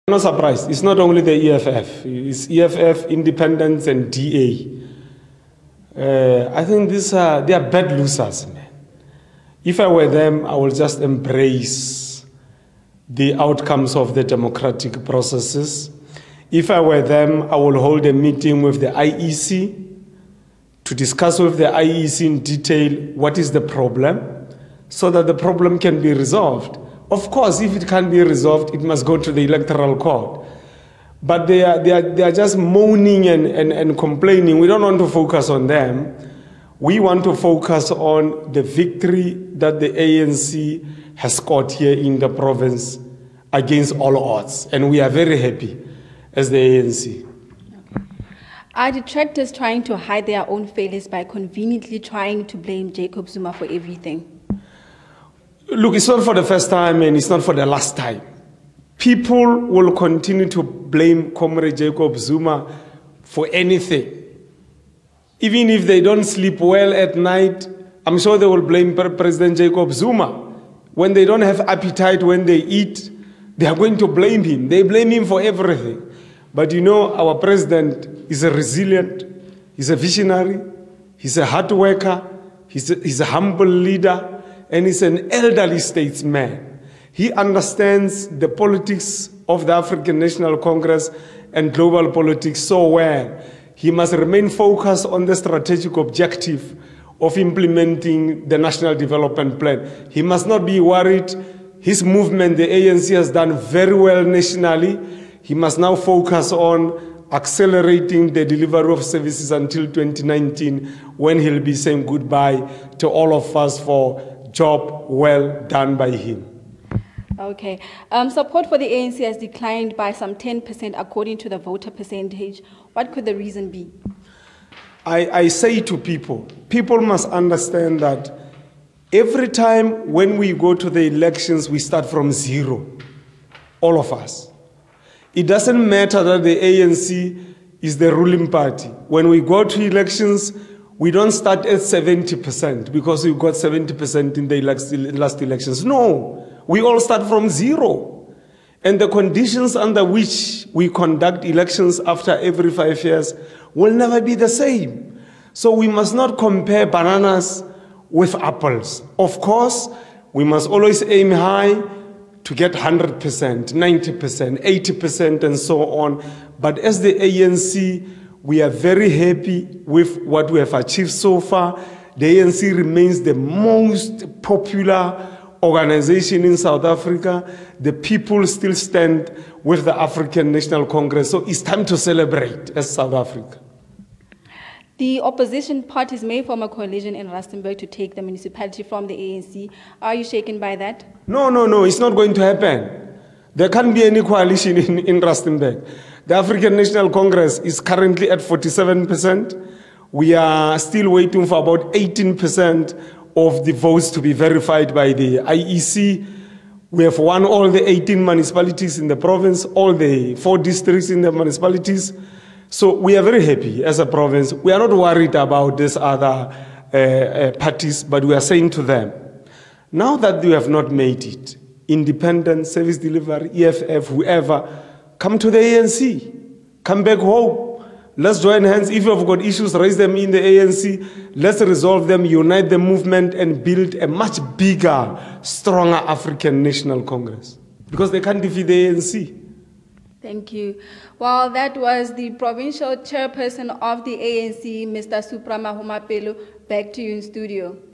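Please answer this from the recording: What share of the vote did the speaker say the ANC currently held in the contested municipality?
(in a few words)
47%.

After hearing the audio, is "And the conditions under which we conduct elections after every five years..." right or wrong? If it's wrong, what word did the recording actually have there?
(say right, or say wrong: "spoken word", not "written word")
right.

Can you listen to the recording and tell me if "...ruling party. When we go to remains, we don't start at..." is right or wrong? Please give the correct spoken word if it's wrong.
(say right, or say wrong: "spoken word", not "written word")
wrong: "elections", not "remains".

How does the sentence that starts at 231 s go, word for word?
Let's resolve them, unite the movement, and build a much bigger, stronger African National Congress.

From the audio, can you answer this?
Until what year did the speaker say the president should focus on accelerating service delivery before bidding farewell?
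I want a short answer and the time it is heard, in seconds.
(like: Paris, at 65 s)
2019, at 109 s.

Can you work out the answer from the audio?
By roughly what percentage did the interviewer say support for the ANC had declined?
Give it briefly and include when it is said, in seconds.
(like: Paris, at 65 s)
10%, at 120 s.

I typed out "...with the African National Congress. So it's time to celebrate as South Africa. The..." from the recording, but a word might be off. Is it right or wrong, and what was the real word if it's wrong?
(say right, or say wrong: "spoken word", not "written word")
right.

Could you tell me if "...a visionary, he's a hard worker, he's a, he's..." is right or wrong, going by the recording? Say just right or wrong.
right.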